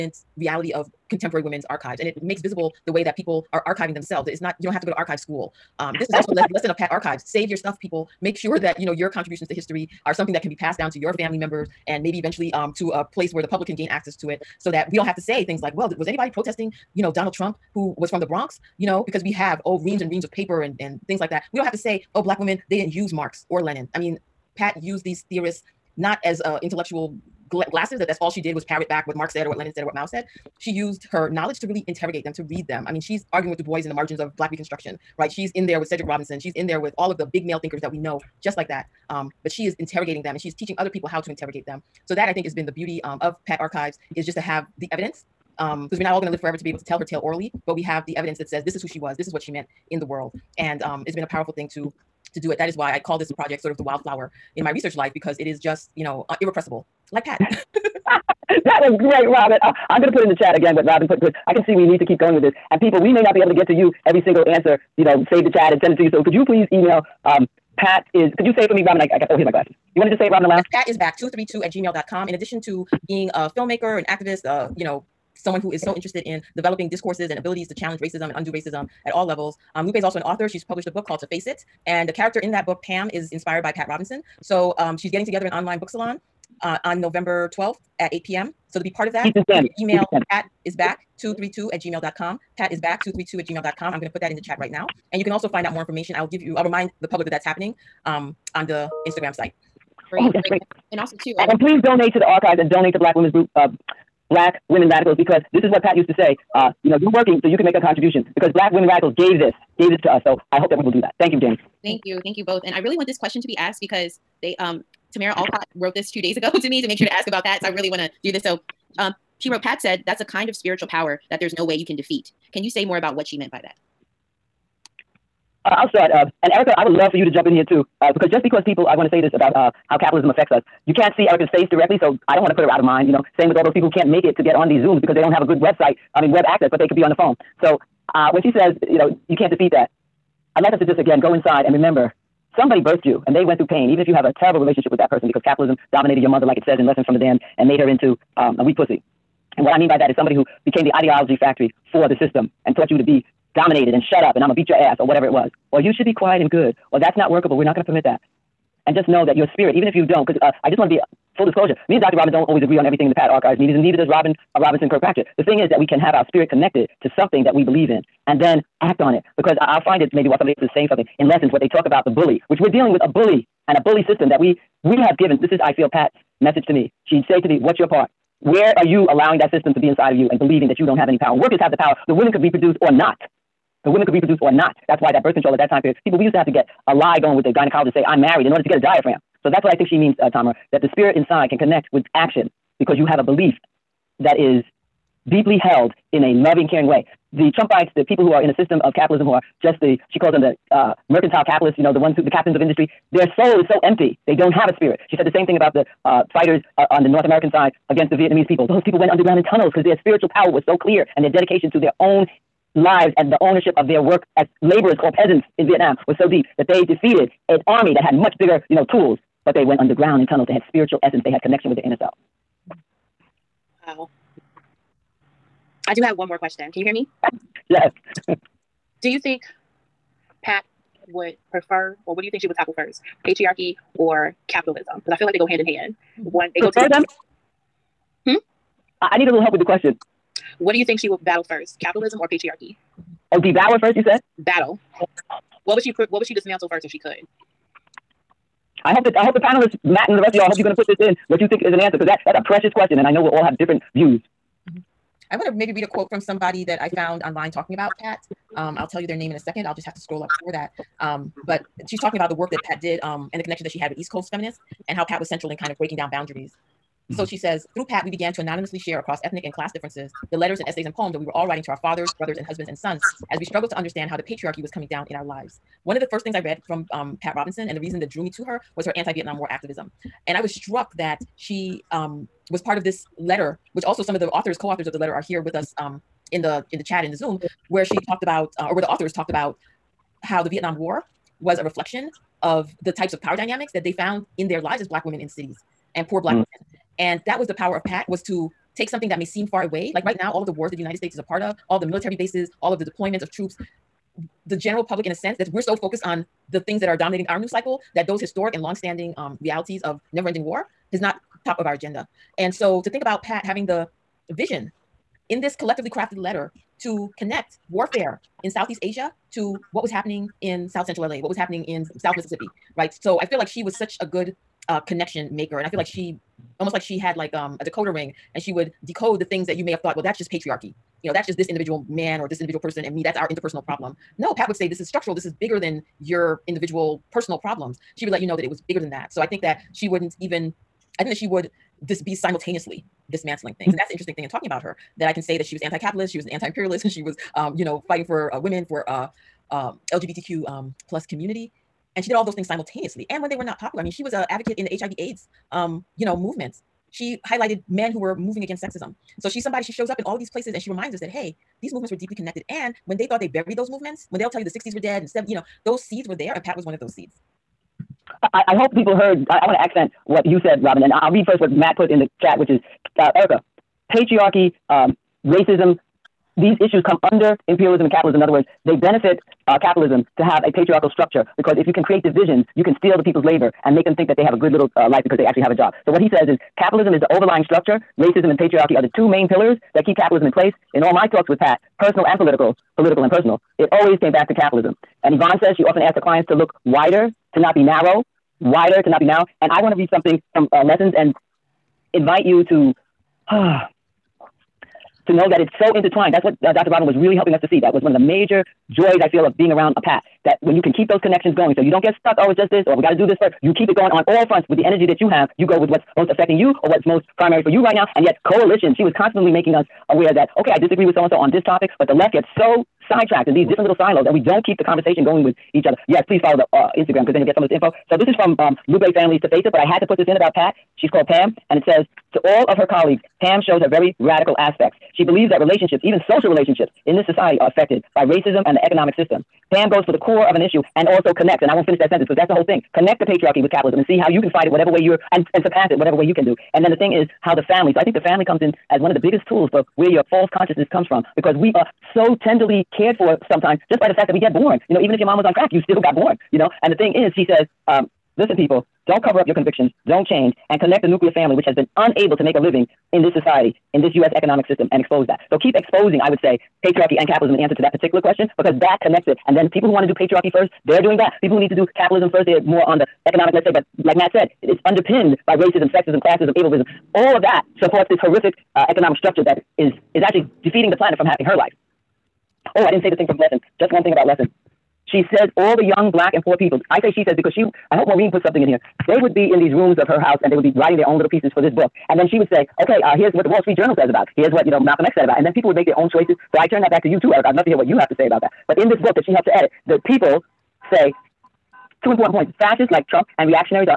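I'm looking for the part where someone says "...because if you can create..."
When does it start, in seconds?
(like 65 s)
381 s.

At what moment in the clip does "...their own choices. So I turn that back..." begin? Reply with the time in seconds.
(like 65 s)
495 s.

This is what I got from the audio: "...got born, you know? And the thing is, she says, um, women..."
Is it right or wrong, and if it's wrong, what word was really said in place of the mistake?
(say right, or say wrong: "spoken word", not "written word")
wrong: "listen", not "women".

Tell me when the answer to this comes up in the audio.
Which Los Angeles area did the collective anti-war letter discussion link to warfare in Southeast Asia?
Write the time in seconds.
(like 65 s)
320 s.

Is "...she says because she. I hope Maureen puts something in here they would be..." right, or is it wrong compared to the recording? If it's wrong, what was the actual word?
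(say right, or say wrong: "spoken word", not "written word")
right.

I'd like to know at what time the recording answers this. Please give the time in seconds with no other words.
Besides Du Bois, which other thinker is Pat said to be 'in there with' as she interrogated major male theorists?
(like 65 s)
35 s.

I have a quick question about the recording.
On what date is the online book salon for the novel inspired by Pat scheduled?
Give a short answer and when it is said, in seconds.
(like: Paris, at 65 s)
November 12th, at 87 s.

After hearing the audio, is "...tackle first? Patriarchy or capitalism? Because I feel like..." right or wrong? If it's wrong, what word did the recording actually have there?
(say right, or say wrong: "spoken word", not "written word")
right.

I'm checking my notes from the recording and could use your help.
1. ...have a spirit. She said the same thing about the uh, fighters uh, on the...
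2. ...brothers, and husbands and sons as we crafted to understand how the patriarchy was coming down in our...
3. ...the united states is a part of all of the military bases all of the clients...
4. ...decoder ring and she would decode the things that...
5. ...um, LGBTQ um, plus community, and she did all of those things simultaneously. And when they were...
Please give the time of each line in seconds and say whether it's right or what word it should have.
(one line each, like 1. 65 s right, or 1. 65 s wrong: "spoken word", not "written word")
1. 204 s right
2. 272 s wrong: "struggled", not "crafted"
3. 300 s wrong: "deployments", not "clients"
4. 327 s right
5. 349 s right.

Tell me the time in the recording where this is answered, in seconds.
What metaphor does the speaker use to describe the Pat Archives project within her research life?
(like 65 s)
53 s.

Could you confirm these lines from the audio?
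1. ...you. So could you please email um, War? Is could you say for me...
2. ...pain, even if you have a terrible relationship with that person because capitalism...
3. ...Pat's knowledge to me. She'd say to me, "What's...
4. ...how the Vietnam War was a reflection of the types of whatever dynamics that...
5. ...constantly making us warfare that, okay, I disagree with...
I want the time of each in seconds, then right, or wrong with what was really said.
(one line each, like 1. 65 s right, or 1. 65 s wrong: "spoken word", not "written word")
1. 66 s wrong: "Pat", not "War"
2. 143 s right
3. 175 s wrong: "message", not "knowledge"
4. 290 s wrong: "power", not "whatever"
5. 418 s wrong: "aware", not "warfare".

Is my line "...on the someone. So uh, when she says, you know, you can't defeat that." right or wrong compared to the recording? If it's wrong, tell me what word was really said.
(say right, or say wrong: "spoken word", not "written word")
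wrong: "phone", not "someone".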